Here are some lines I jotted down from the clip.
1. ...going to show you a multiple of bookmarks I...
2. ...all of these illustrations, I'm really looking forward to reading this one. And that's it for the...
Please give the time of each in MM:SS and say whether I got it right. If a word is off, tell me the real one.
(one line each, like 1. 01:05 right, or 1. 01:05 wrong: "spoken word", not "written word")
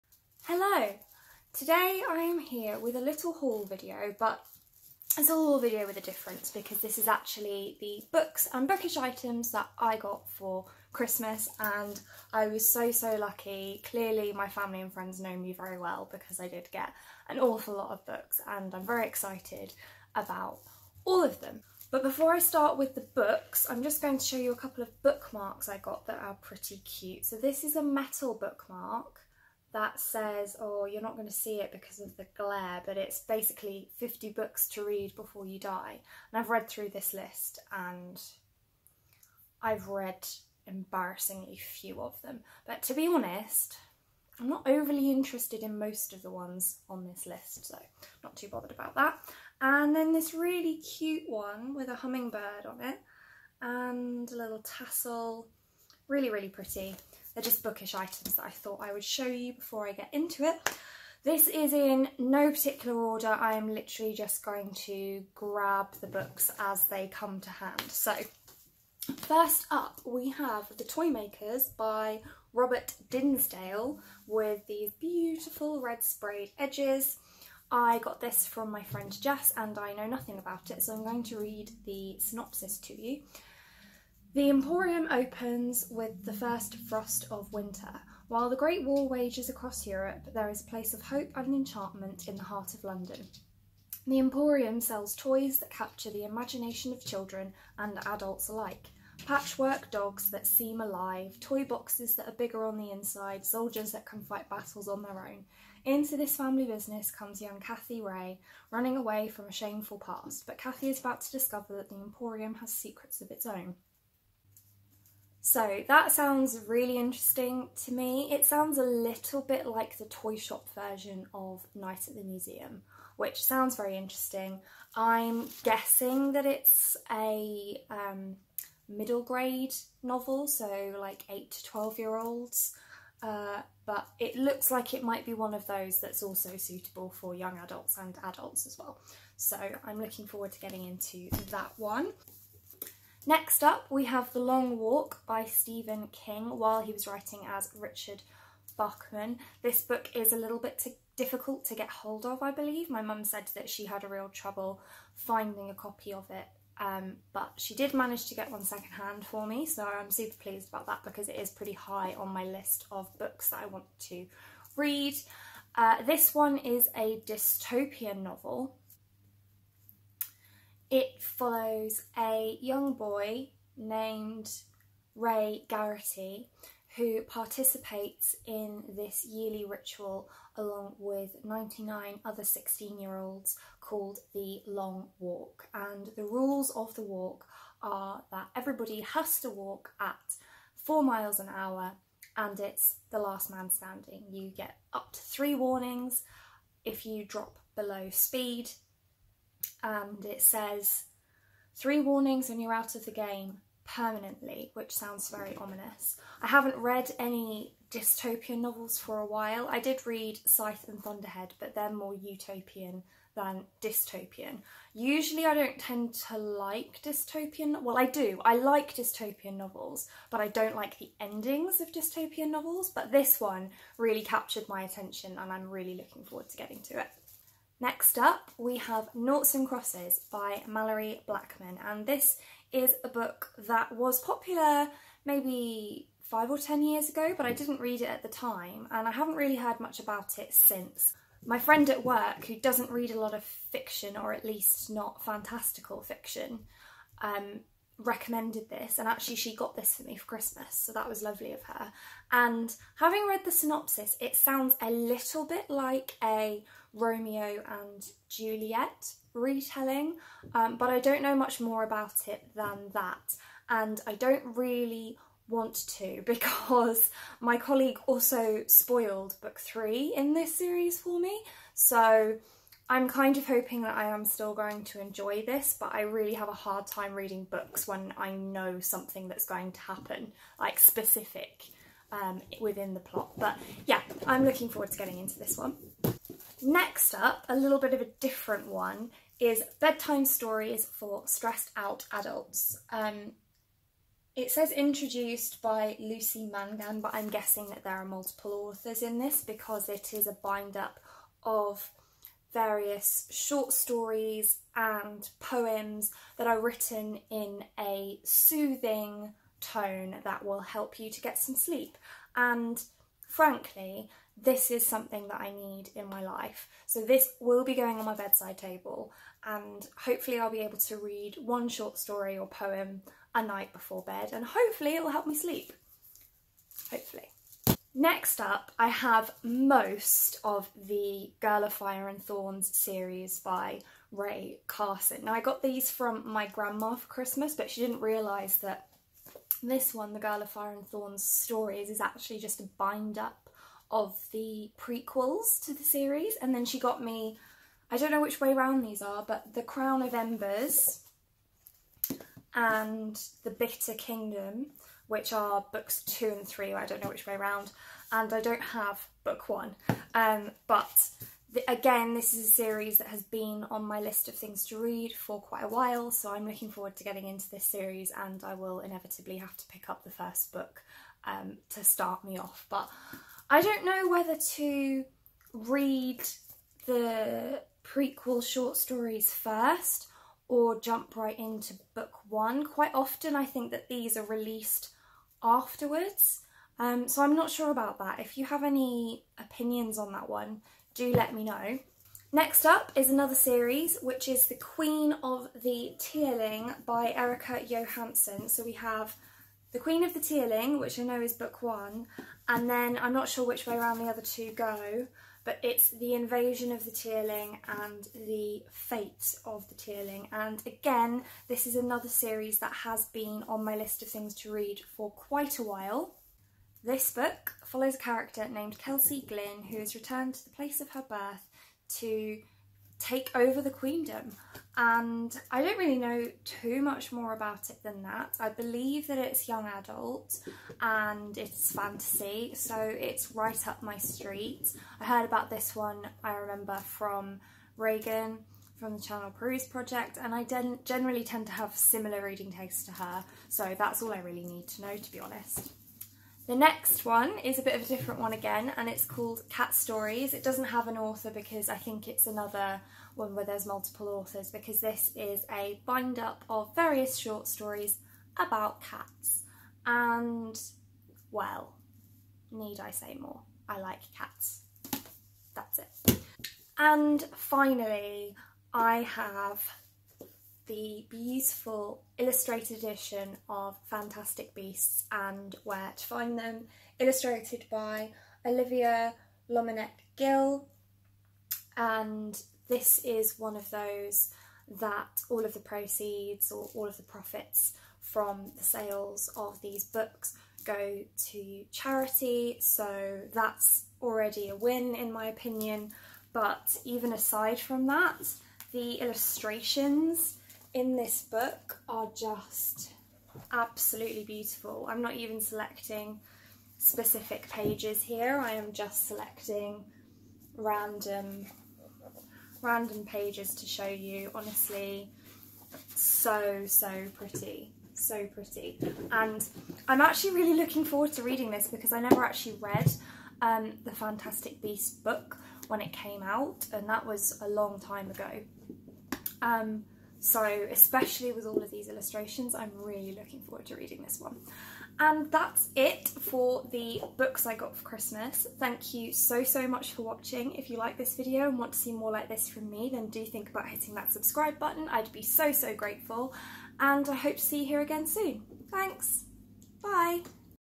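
1. 00:24 wrong: "couple", not "multiple"
2. 08:51 right.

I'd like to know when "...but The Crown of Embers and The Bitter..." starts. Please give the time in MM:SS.
05:49.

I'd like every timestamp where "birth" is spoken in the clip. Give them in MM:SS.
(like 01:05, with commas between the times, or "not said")
07:01.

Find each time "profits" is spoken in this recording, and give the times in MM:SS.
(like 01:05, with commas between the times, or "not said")
08:07.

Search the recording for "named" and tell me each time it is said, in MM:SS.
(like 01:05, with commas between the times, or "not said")
02:53, 06:58.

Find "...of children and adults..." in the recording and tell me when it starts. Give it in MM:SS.
01:36.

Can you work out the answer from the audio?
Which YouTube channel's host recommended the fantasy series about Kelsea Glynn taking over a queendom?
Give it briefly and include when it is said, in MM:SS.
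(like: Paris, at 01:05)
PeruseProject, at 07:19.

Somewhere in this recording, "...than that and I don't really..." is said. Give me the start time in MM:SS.
04:22.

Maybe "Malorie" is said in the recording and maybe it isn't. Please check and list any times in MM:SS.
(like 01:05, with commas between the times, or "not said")
03:50.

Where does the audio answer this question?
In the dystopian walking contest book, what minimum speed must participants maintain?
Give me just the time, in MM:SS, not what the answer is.
03:10.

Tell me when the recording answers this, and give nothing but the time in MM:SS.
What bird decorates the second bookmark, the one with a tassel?
00:51.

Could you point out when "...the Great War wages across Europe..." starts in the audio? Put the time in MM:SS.
01:28.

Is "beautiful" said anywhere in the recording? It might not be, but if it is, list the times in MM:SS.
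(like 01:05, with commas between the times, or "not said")
01:14, 07:51, 08:24.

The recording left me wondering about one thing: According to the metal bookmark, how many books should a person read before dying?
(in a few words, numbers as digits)
50.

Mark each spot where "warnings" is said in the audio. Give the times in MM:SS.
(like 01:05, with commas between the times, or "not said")
03:15, 03:21.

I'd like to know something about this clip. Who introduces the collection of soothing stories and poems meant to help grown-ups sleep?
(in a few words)
Lucy Mangan.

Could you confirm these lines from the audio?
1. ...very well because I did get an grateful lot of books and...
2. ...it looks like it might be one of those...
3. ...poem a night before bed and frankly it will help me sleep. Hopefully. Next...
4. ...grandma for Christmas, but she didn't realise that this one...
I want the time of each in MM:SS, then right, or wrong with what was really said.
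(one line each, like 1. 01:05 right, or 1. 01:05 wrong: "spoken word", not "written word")
1. 00:15 wrong: "awful", not "grateful"
2. 02:14 right
3. 05:22 wrong: "hopefully", not "frankly"
4. 05:36 right.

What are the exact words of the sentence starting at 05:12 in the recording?
And frankly, this is something that I need in my life.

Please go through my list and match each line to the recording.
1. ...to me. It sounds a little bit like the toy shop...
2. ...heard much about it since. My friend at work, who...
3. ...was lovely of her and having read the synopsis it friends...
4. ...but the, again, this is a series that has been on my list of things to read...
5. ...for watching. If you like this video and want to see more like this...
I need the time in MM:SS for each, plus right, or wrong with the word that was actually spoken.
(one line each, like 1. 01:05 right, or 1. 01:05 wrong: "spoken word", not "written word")
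1. 01:57 right
2. 03:59 right
3. 04:11 wrong: "sounds", not "friends"
4. 06:00 right
5. 08:59 right.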